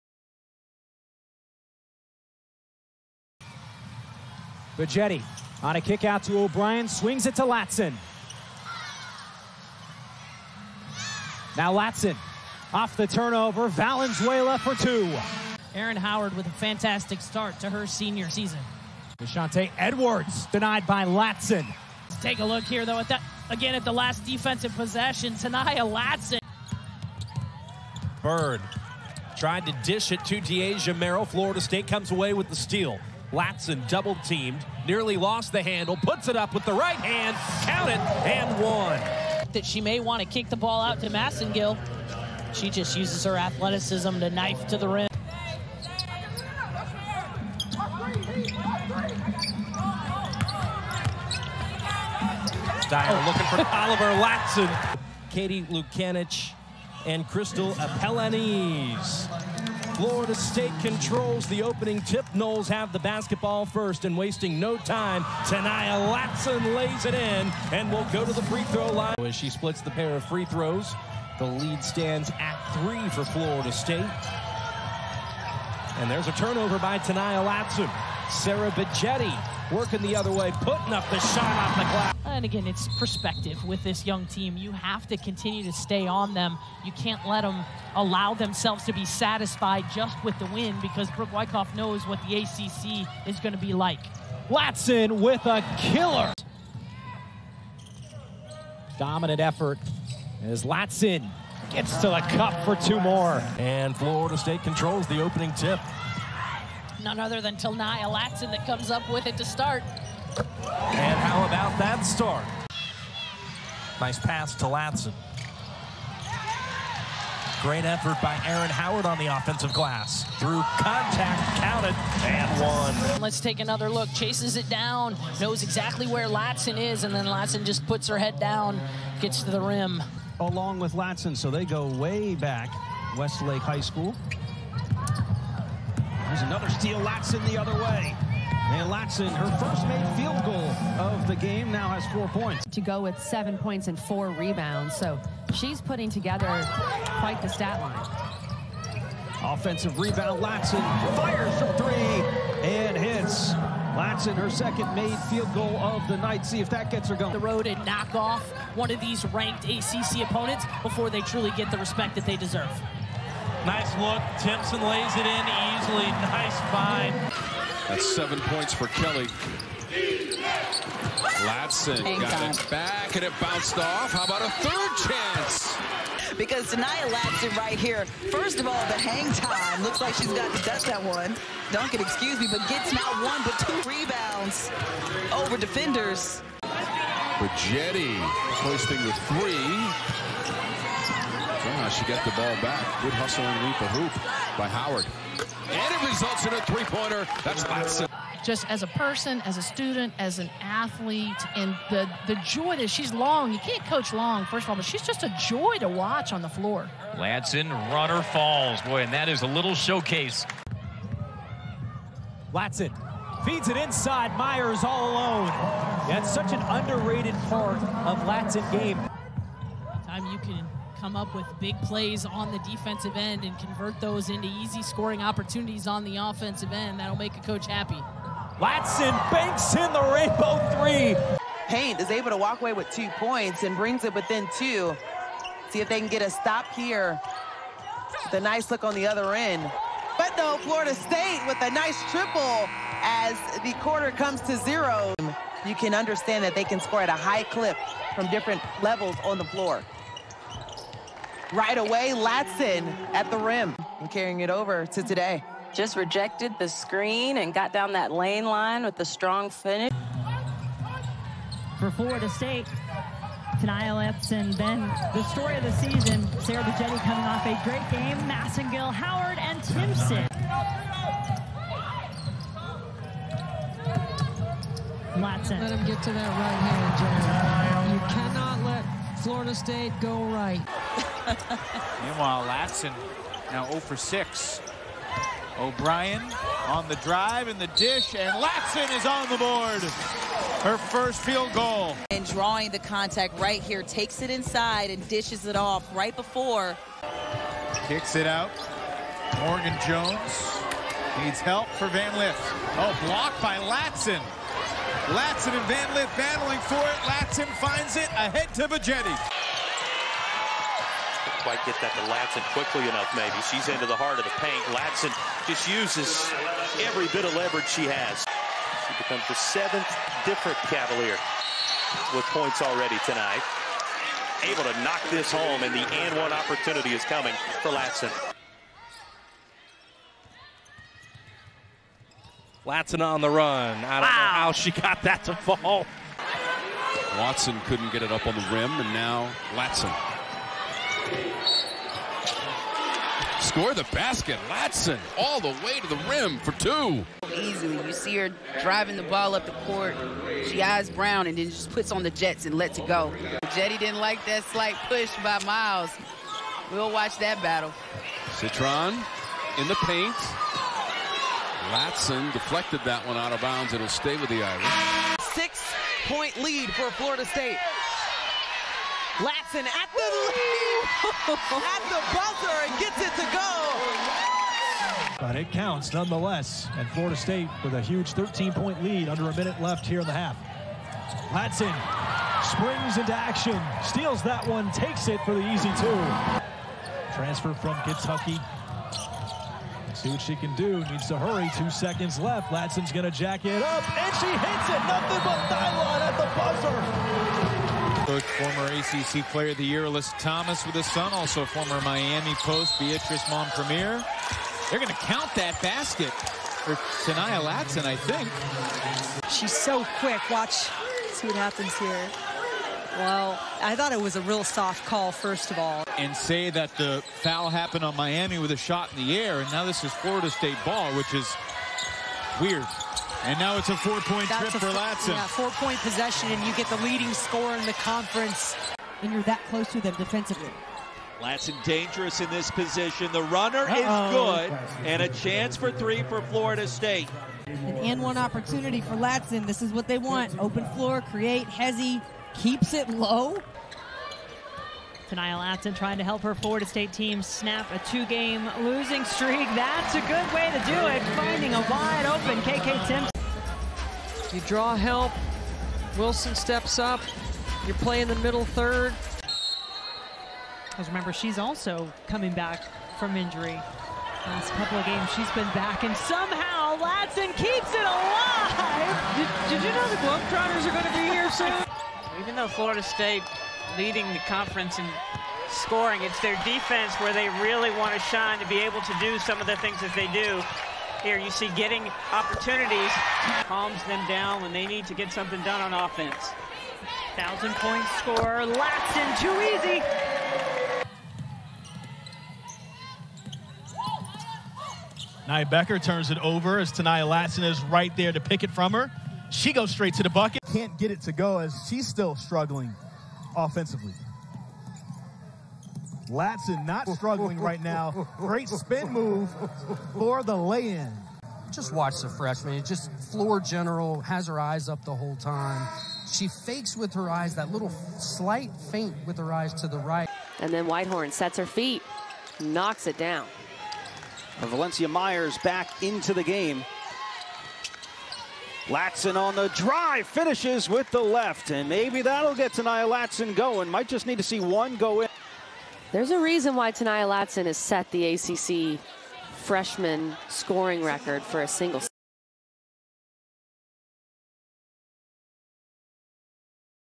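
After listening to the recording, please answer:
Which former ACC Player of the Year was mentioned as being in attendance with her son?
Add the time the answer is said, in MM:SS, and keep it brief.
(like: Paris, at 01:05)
Alyssa Thomas, at 06:39.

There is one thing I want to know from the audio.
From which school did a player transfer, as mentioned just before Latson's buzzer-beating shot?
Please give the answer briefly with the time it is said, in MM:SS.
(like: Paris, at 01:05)
Kentucky, at 06:27.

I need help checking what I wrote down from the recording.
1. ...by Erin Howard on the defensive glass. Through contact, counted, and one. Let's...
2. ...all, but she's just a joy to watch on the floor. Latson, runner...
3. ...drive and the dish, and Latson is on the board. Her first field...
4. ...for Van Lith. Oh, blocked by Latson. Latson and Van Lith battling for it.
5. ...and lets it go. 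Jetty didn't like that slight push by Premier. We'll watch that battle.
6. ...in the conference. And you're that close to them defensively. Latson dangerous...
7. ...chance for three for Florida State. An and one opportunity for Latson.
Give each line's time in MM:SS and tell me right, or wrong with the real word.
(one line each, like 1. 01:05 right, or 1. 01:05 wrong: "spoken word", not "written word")
1. 01:58 wrong: "offensive", not "defensive"
2. 03:24 right
3. 04:46 right
4. 05:01 right
5. 05:52 wrong: "Miles", not "Premier"
6. 07:07 right
7. 07:15 right.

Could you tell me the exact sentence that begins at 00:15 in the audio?
Erin Howard with a fantastic start to her senior season.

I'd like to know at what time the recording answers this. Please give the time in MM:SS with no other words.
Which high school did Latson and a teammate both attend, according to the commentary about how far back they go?
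02:13.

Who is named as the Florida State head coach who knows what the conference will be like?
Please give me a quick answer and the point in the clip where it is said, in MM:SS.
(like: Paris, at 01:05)
Brooke Wyckoff, at 01:31.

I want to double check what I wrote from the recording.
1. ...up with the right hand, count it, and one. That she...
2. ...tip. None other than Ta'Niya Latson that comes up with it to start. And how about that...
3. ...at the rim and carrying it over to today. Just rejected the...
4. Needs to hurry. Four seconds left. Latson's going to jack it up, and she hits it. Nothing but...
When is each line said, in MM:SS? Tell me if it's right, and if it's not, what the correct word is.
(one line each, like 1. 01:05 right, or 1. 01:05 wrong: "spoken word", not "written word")
1. 00:36 right
2. 01:45 right
3. 04:13 right
4. 06:30 wrong: "Two", not "Four".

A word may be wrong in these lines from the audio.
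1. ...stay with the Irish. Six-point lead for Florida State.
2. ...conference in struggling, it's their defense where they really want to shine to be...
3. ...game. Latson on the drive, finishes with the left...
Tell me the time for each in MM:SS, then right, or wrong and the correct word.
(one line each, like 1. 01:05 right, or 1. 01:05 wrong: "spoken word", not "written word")
1. 06:03 right
2. 07:54 wrong: "scoring", not "struggling"
3. 08:46 right.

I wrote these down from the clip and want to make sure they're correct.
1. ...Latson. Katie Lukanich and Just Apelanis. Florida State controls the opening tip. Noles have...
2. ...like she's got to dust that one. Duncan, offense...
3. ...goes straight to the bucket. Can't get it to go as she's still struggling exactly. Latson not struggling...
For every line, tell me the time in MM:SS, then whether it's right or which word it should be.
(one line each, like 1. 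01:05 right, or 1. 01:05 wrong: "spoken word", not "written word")
1. 00:54 wrong: "Crystal", not "Just"
2. 02:59 wrong: "excuse", not "offense"
3. 08:19 wrong: "offensively", not "exactly".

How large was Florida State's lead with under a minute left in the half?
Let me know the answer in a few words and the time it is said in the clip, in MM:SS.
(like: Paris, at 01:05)
13 points, at 06:18.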